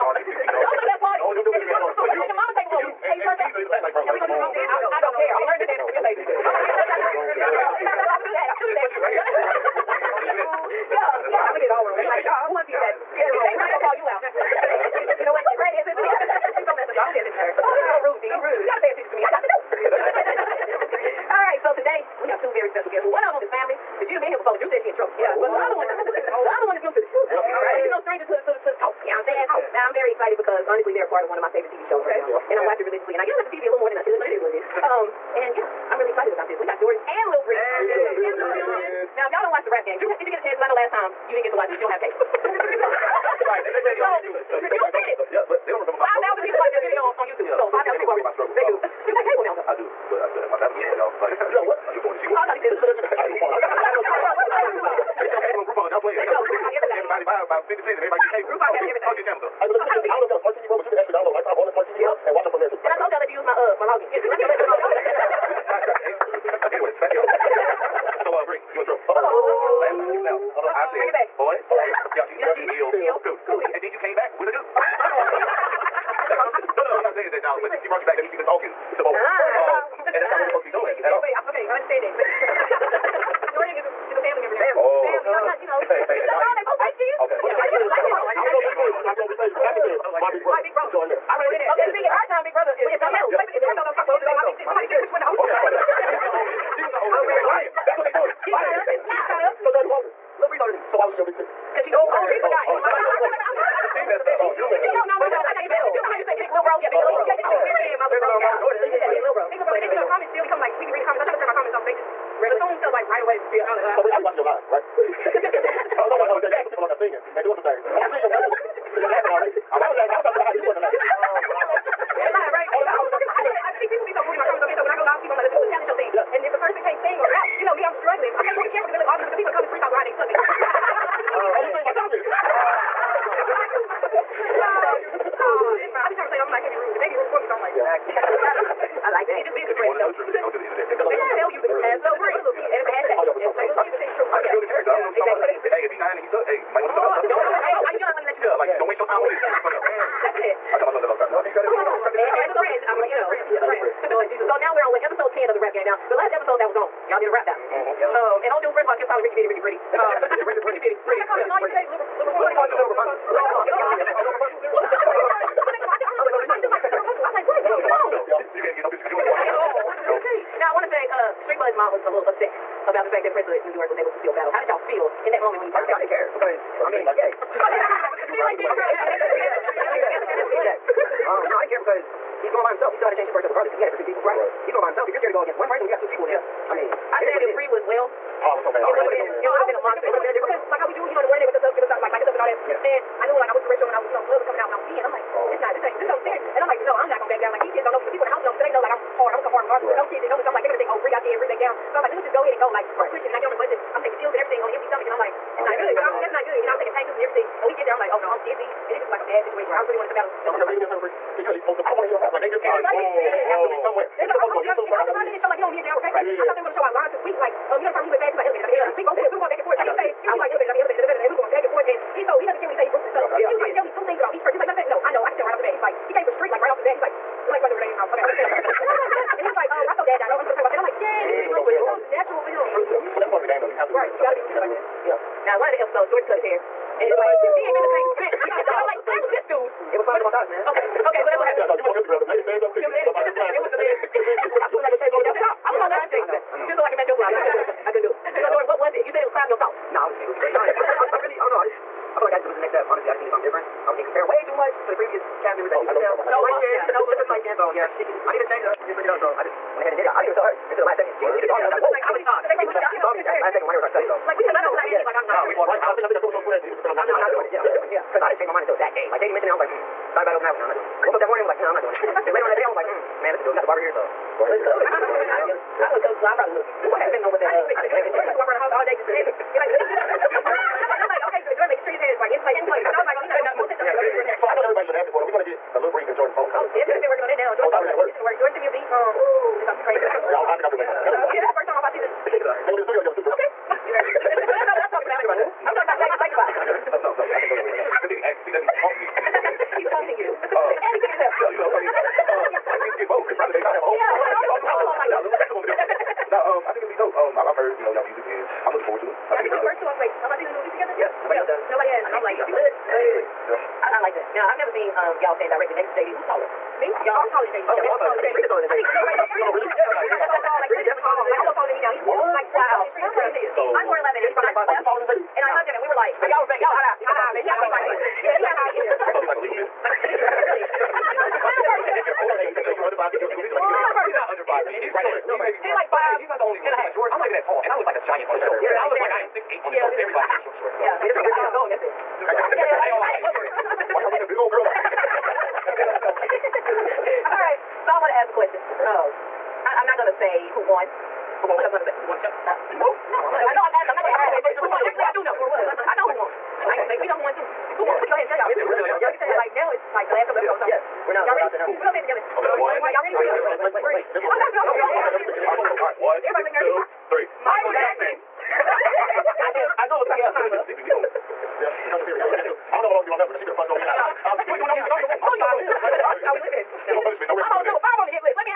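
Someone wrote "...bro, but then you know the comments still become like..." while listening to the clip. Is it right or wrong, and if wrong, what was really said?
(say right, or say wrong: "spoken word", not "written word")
right.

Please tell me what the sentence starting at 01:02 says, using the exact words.
bro, and watch them from there too.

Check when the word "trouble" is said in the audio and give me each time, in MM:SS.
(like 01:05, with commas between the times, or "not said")
00:24, 01:08.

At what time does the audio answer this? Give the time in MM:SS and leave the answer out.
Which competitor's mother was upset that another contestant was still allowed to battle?
02:51.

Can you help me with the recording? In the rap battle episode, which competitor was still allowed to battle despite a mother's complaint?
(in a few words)
Prince of New York.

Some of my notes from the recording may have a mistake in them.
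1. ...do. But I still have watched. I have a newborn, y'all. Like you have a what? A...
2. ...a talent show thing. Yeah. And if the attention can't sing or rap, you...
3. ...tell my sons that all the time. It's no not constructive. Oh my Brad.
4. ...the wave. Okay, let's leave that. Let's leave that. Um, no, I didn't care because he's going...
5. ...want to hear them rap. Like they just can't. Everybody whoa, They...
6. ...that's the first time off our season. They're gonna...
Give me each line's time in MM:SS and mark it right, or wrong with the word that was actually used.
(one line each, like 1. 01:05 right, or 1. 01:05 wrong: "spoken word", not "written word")
1. 00:49 right
2. 02:05 wrong: "person", not "attention"
3. 02:30 wrong: "God", not "Brad"
4. 02:58 right
5. 03:31 right
6. 04:51 right.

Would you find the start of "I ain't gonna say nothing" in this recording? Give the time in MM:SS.
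05:56.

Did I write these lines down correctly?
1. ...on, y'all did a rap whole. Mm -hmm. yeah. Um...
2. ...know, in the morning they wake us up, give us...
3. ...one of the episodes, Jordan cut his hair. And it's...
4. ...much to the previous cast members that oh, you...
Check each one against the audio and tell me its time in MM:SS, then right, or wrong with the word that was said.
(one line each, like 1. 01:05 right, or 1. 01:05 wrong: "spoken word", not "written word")
1. 02:36 wrong: "battle", not "whole"
2. 03:11 right
3. 03:55 right
4. 04:14 right.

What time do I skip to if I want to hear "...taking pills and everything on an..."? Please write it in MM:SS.
03:24.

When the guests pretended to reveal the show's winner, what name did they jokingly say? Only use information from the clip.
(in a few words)
Michael Jackson.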